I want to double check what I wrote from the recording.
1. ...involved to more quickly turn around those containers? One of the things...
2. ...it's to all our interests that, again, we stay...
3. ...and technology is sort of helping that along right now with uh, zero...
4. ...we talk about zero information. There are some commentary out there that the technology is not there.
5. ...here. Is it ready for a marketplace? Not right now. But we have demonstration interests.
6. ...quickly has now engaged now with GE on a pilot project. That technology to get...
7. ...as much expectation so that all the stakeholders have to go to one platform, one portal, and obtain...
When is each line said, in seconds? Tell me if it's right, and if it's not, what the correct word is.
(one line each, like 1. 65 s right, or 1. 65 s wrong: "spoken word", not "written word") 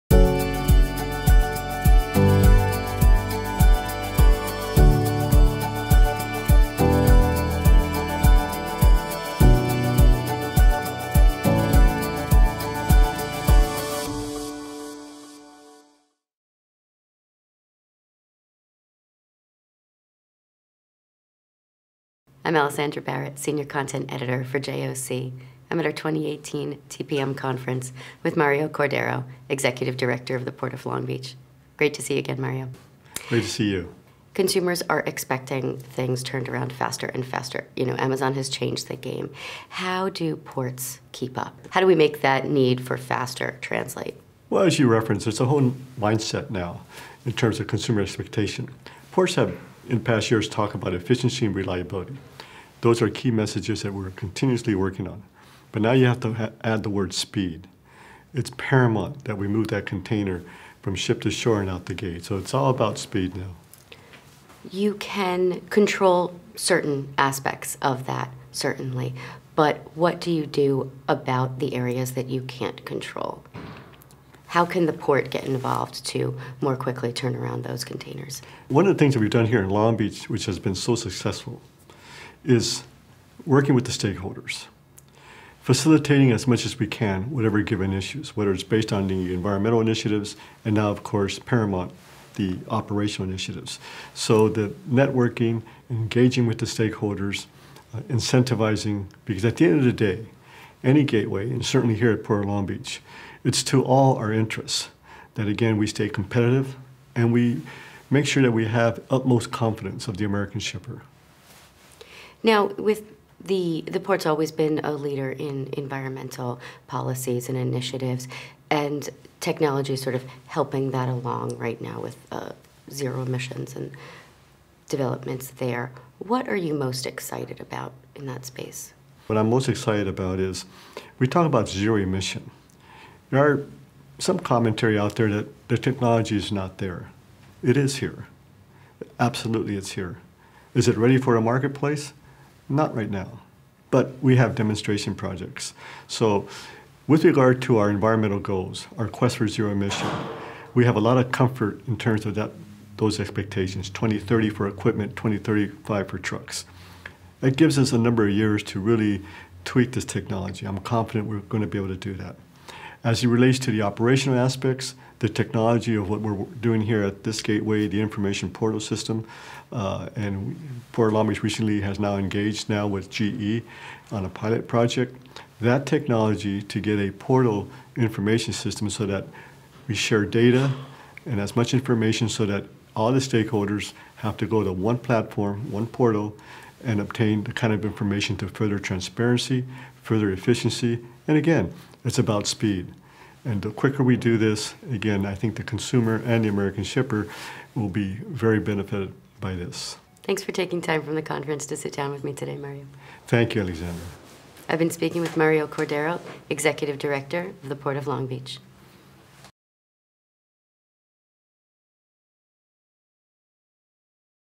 1. 75 s right
2. 103 s right
3. 118 s right
4. 131 s wrong: "emission", not "information"
5. 139 s wrong: "projects", not "interests"
6. 171 s wrong: "recently", not "quickly"
7. 181 s wrong: "information", not "expectation".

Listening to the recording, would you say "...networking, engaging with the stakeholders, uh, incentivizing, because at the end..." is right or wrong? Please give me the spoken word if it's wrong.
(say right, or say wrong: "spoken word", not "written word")
right.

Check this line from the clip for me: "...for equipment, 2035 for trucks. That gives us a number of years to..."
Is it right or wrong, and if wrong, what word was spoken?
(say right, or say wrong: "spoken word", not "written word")
right.